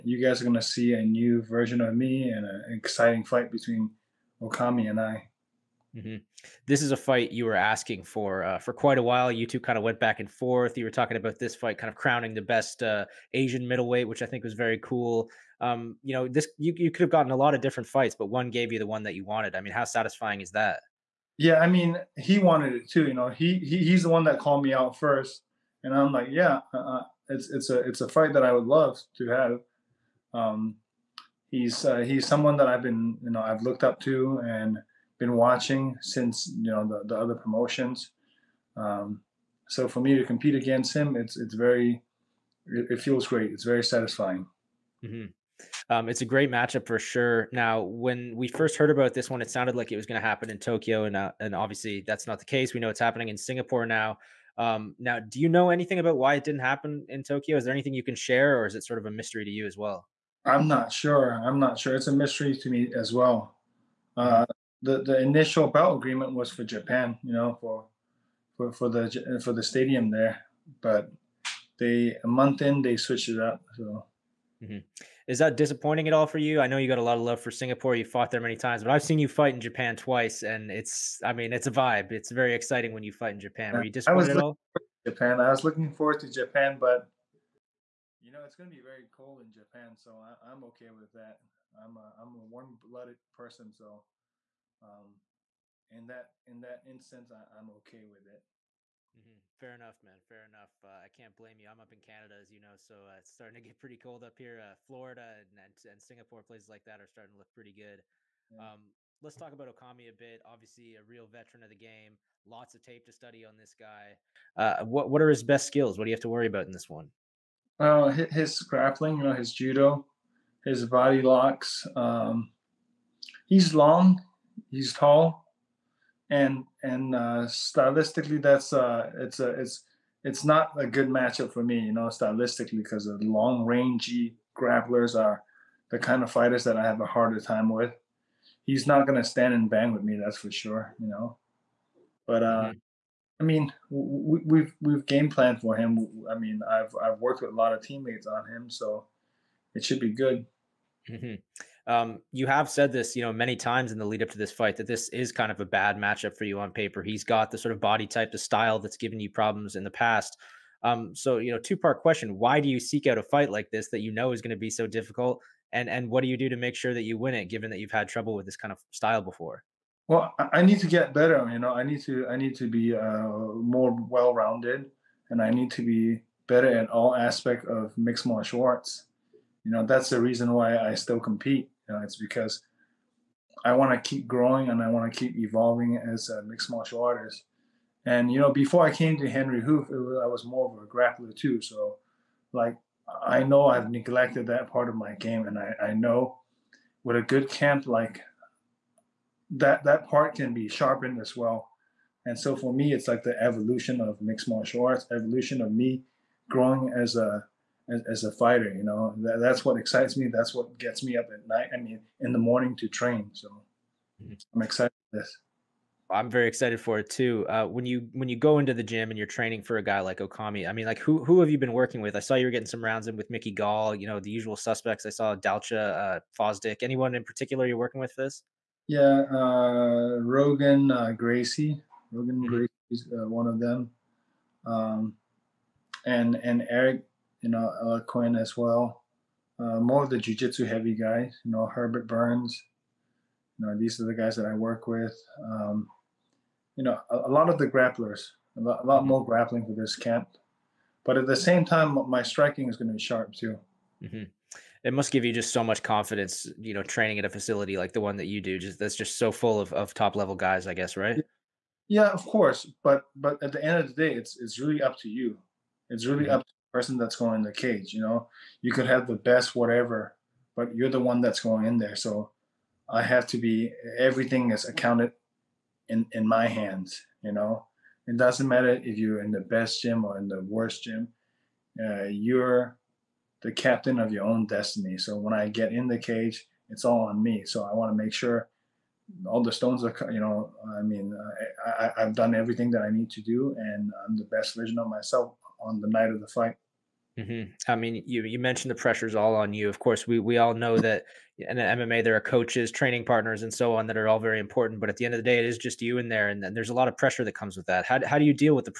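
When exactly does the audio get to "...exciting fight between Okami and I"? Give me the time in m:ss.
0:02.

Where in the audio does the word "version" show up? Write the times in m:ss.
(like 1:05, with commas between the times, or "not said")
0:01, 4:54.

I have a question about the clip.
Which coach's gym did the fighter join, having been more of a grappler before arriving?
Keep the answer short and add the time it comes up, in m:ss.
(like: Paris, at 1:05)
Henri Hooft, at 3:09.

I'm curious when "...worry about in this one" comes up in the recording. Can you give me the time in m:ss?
1:56.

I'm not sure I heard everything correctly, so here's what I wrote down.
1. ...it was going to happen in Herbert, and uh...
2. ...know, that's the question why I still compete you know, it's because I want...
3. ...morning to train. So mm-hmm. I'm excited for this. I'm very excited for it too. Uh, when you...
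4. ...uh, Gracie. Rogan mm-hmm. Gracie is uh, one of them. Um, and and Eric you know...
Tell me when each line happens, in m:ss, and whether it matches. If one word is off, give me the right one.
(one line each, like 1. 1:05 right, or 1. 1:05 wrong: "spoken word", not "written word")
1. 0:49 wrong: "Tokyo", not "Herbert"
2. 2:59 wrong: "reason", not "question"
3. 3:32 right
4. 3:50 right.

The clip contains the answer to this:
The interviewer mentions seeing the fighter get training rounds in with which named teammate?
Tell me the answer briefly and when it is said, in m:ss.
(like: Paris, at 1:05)
Mickey Gall, at 3:43.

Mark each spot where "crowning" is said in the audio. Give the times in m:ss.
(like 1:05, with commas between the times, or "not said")
0:11.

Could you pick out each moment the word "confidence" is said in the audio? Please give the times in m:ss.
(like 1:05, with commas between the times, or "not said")
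4:15.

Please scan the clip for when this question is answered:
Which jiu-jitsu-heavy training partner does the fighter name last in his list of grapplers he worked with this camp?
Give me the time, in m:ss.
4:01.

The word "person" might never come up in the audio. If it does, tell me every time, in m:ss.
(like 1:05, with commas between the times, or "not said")
1:33, 4:26.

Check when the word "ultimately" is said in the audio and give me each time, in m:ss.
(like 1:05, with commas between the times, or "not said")
not said.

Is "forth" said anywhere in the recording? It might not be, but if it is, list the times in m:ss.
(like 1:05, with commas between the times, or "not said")
0:10.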